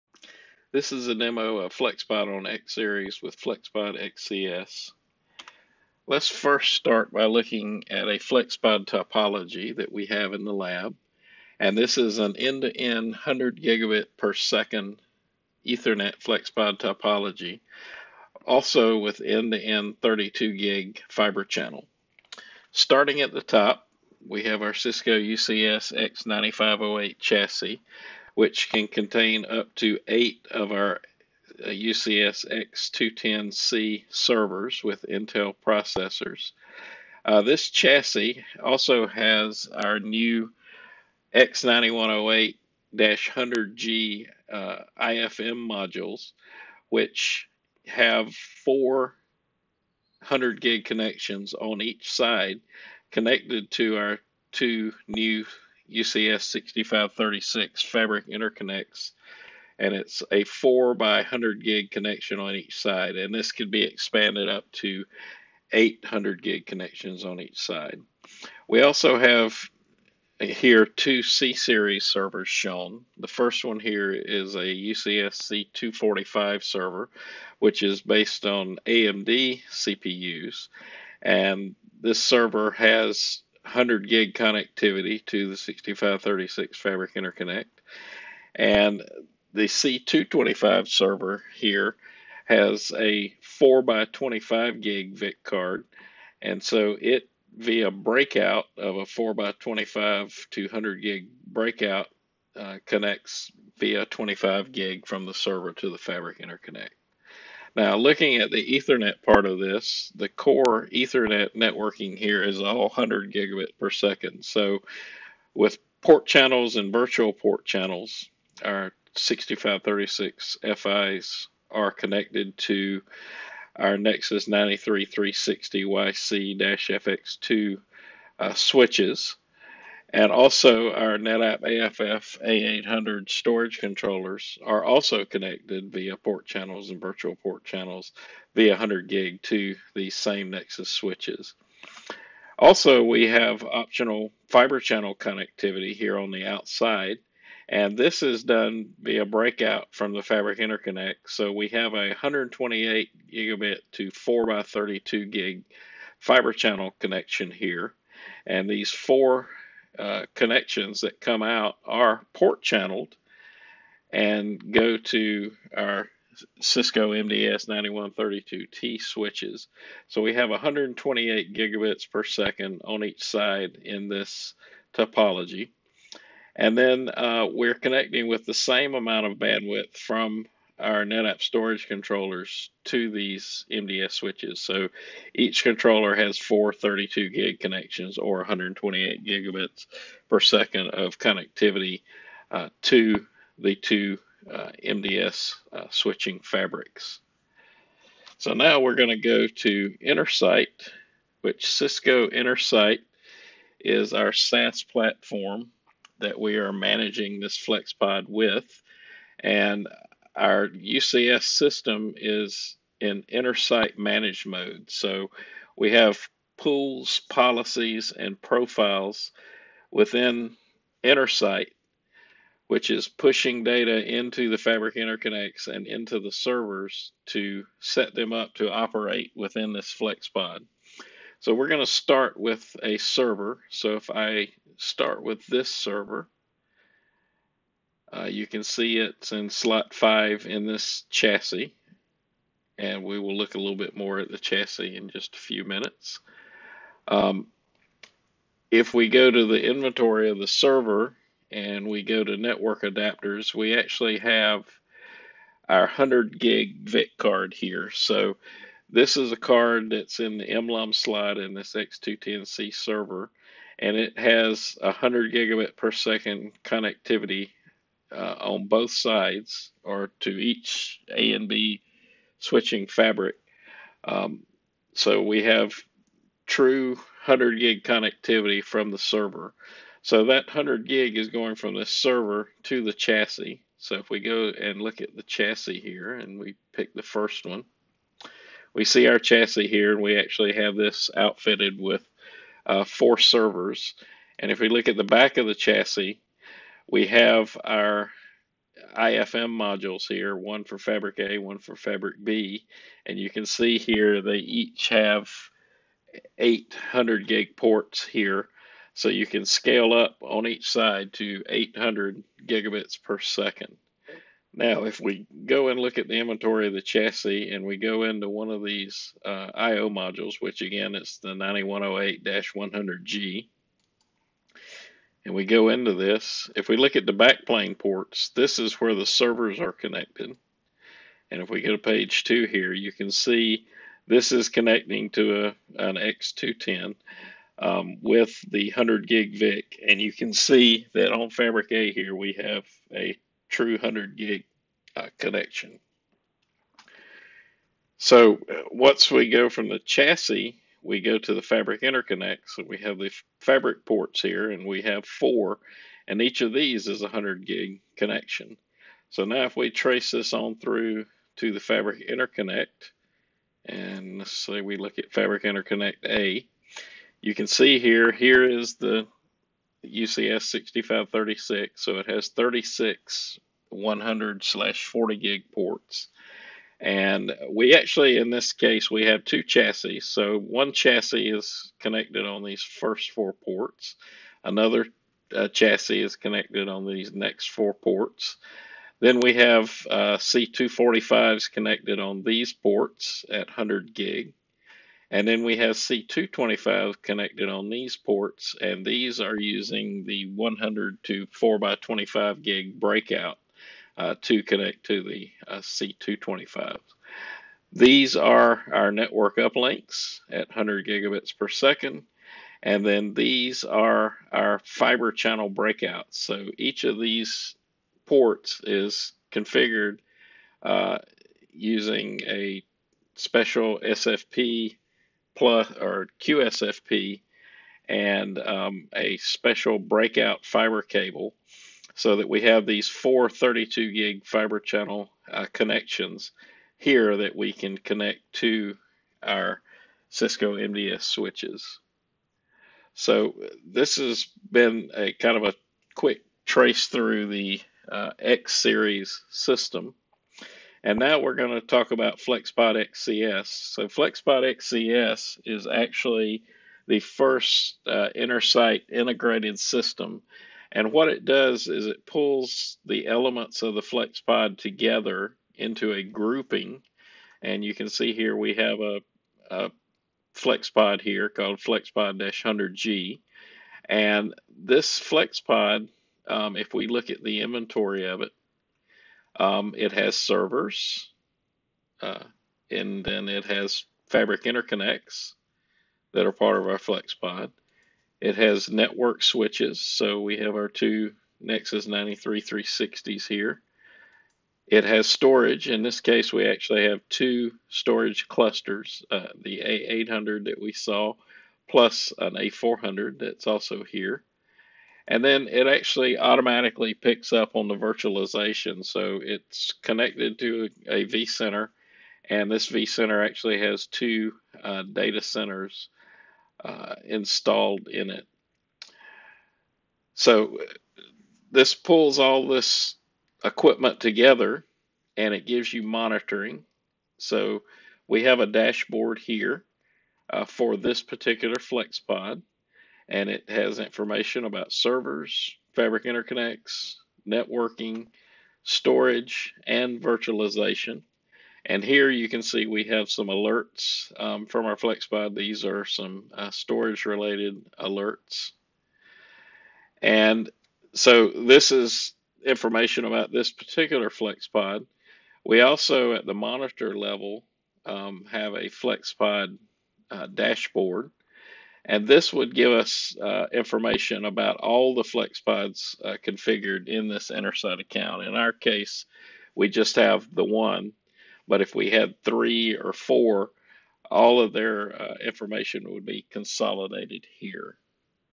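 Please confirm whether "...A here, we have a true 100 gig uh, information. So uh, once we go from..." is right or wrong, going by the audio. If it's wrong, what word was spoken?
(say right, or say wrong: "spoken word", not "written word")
wrong: "connection", not "information".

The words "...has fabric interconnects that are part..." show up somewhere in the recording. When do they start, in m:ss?
8:03.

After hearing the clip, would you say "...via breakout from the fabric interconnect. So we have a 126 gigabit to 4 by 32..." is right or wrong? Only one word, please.
wrong.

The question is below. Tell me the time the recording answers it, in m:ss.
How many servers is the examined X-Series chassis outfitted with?
4:52.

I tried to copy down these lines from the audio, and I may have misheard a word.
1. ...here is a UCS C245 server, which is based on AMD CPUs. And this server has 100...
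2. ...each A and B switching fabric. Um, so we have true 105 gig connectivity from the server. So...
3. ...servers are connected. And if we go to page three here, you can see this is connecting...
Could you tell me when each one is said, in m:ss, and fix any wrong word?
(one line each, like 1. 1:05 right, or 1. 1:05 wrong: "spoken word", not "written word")
1. 1:13 right
2. 4:30 wrong: "100", not "105"
3. 5:29 wrong: "two", not "three".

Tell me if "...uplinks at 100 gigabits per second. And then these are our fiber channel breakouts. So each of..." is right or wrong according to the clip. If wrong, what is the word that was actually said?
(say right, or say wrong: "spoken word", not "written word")
right.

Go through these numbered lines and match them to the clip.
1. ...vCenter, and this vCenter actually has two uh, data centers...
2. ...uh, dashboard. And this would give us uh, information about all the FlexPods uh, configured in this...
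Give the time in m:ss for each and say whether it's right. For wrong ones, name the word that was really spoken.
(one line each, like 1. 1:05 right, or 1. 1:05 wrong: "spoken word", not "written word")
1. 8:31 right
2. 9:20 right.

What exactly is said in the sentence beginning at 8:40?
So this pulls all this equipment together and it gives you monitoring.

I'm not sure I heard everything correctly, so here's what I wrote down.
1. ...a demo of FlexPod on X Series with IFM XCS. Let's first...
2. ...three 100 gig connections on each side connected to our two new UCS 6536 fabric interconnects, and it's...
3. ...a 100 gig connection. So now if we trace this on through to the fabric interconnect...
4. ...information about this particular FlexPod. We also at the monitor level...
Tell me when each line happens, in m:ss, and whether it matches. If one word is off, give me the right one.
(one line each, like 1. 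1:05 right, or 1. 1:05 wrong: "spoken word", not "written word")
1. 0:01 wrong: "FlexPod", not "IFM"
2. 0:48 wrong: "four", not "three"
3. 5:57 right
4. 9:12 right.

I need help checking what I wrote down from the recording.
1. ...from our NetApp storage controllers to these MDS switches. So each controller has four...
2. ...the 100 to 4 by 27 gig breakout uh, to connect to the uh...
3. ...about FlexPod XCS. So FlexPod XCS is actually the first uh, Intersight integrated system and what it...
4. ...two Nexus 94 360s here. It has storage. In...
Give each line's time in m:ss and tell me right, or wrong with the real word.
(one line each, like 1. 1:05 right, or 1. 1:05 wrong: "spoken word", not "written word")
1. 2:59 right
2. 6:40 wrong: "25", not "27"
3. 7:31 right
4. 8:10 wrong: "93", not "94".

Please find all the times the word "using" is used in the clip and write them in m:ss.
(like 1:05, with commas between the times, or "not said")
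6:39, 7:01.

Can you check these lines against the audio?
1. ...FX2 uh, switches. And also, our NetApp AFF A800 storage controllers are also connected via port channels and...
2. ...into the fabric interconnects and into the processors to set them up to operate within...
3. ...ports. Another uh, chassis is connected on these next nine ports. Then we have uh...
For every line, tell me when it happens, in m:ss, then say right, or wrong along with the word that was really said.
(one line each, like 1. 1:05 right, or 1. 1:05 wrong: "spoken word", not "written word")
1. 2:06 right
2. 3:44 wrong: "servers", not "processors"
3. 6:23 wrong: "four", not "nine".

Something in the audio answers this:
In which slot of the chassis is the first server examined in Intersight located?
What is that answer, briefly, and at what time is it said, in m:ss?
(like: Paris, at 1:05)
5, at 3:59.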